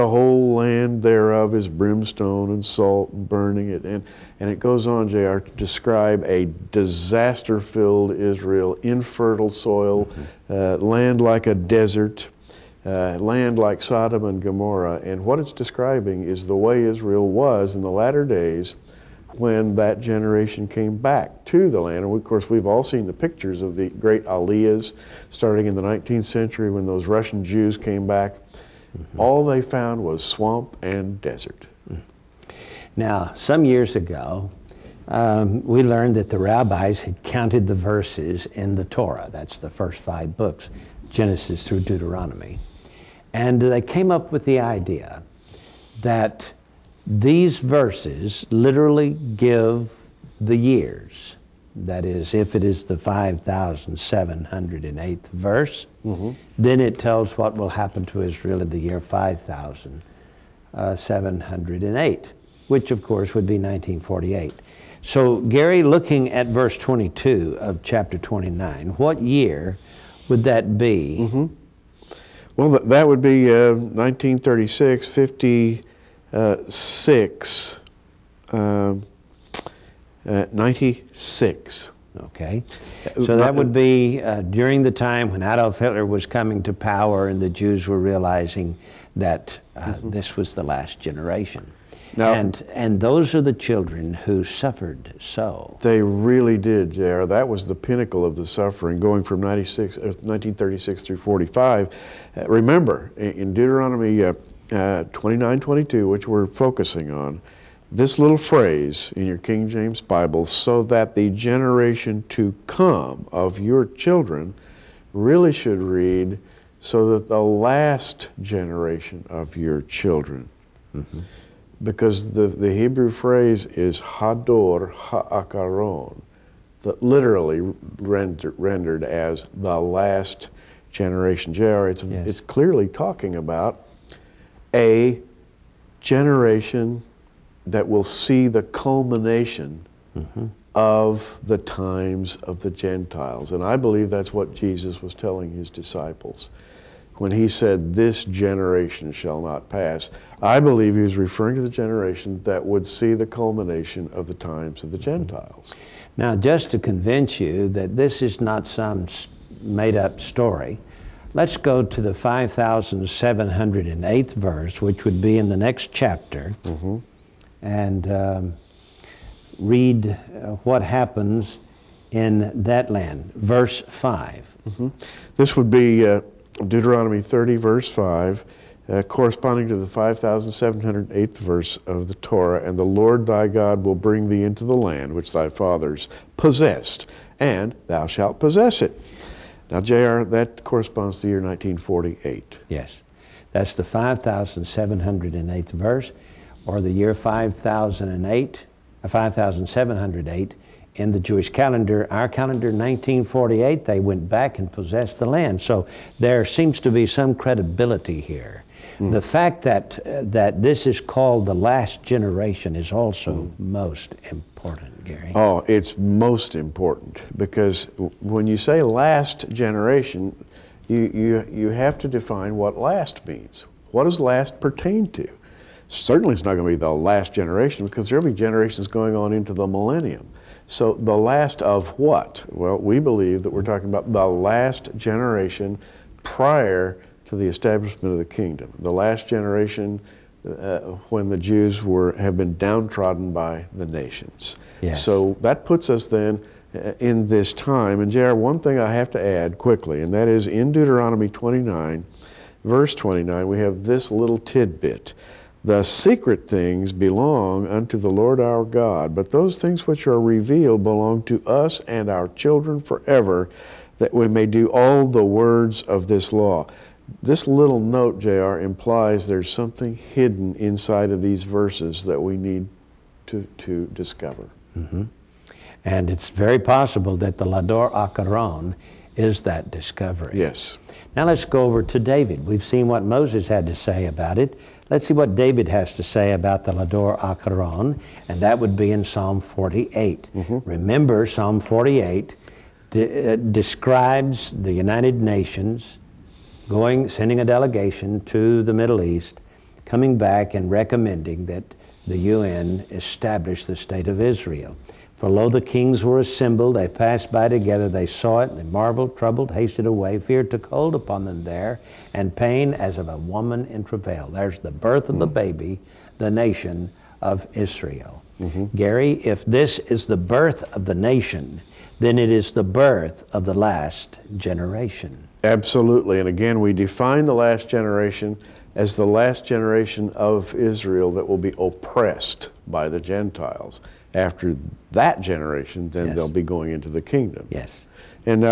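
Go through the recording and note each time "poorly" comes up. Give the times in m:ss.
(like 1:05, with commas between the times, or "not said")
not said.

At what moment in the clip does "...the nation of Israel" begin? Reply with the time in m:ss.
5:16.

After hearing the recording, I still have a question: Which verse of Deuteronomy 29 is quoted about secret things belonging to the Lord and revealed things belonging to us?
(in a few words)
Verse 29.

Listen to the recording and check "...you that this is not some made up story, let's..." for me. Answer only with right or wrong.
right.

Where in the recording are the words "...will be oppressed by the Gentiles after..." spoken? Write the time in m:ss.
5:31.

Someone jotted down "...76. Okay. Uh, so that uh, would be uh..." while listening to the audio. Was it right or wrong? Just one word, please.
wrong.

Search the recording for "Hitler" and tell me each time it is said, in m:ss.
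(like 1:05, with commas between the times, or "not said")
1:25.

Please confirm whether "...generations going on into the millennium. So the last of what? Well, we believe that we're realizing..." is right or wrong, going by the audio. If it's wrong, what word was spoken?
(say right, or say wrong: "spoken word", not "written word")
wrong: "talking", not "realizing".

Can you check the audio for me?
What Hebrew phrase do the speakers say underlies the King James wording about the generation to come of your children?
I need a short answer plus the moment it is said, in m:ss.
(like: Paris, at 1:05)
Hador Haacharon, at 2:04.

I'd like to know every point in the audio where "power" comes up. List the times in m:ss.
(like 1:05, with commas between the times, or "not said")
1:26.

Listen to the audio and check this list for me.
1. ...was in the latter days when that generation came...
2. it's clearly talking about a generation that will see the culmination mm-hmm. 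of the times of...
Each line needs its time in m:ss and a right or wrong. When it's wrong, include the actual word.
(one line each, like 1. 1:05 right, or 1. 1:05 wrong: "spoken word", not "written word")
1. 0:17 right
2. 2:12 right.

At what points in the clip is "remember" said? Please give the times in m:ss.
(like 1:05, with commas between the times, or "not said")
1:42, 4:50.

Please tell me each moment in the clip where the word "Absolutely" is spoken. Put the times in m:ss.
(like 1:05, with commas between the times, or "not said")
5:25.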